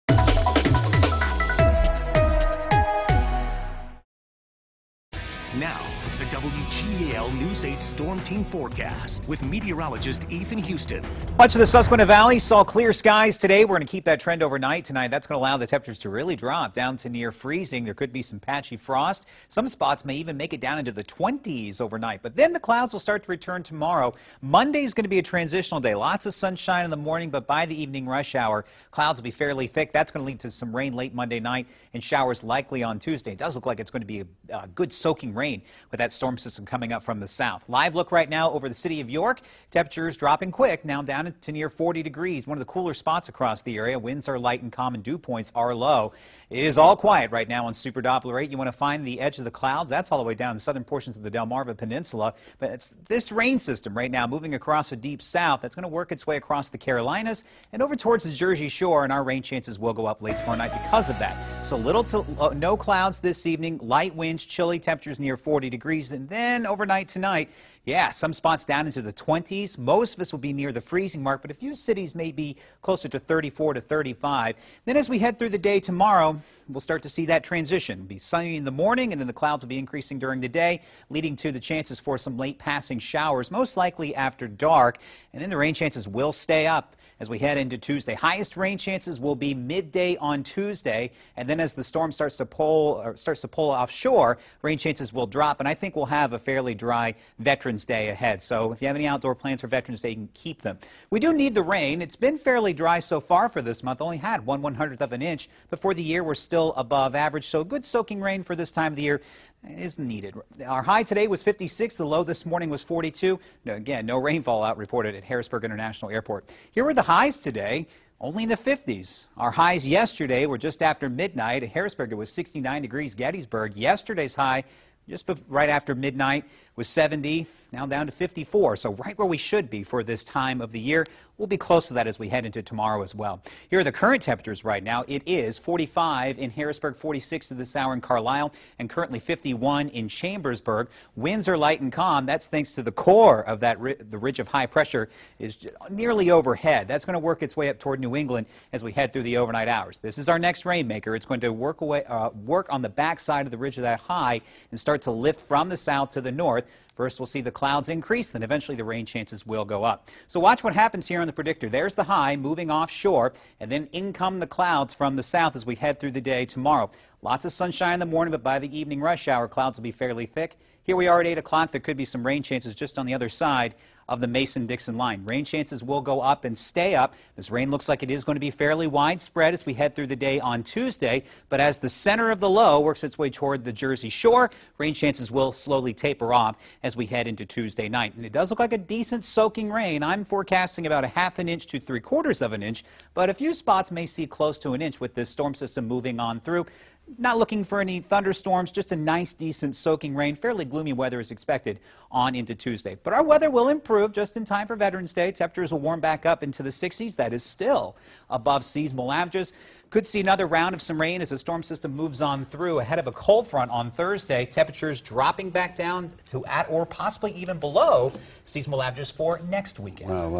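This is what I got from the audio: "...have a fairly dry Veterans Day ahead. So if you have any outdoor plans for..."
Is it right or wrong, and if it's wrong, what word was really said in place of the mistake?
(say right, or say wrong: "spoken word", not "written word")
right.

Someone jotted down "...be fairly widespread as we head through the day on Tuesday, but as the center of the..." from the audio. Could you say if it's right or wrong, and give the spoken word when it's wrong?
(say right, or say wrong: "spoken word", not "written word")
right.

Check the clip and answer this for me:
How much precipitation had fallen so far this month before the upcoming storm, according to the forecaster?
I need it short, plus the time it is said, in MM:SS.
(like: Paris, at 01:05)
0.01 inch, at 01:44.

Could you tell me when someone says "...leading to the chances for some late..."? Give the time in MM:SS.
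01:21.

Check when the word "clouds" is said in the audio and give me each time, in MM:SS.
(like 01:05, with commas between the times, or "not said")
00:22, 00:28, 00:49, 01:02, 01:19, 02:37, 02:44, 02:49.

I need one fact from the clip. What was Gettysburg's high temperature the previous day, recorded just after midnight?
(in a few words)
70.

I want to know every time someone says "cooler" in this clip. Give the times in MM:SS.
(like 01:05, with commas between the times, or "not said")
00:42.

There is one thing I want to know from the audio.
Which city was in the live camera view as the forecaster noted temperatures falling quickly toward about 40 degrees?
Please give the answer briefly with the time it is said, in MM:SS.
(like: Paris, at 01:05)
York, at 00:39.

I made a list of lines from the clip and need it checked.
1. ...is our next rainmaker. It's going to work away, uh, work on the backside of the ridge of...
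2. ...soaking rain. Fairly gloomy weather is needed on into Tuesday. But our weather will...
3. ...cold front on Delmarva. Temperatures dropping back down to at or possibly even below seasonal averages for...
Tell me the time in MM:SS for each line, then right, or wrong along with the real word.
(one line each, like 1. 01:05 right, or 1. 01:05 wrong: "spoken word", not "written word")
1. 02:30 right
2. 03:19 wrong: "expected", not "needed"
3. 03:33 wrong: "Thursday", not "Delmarva".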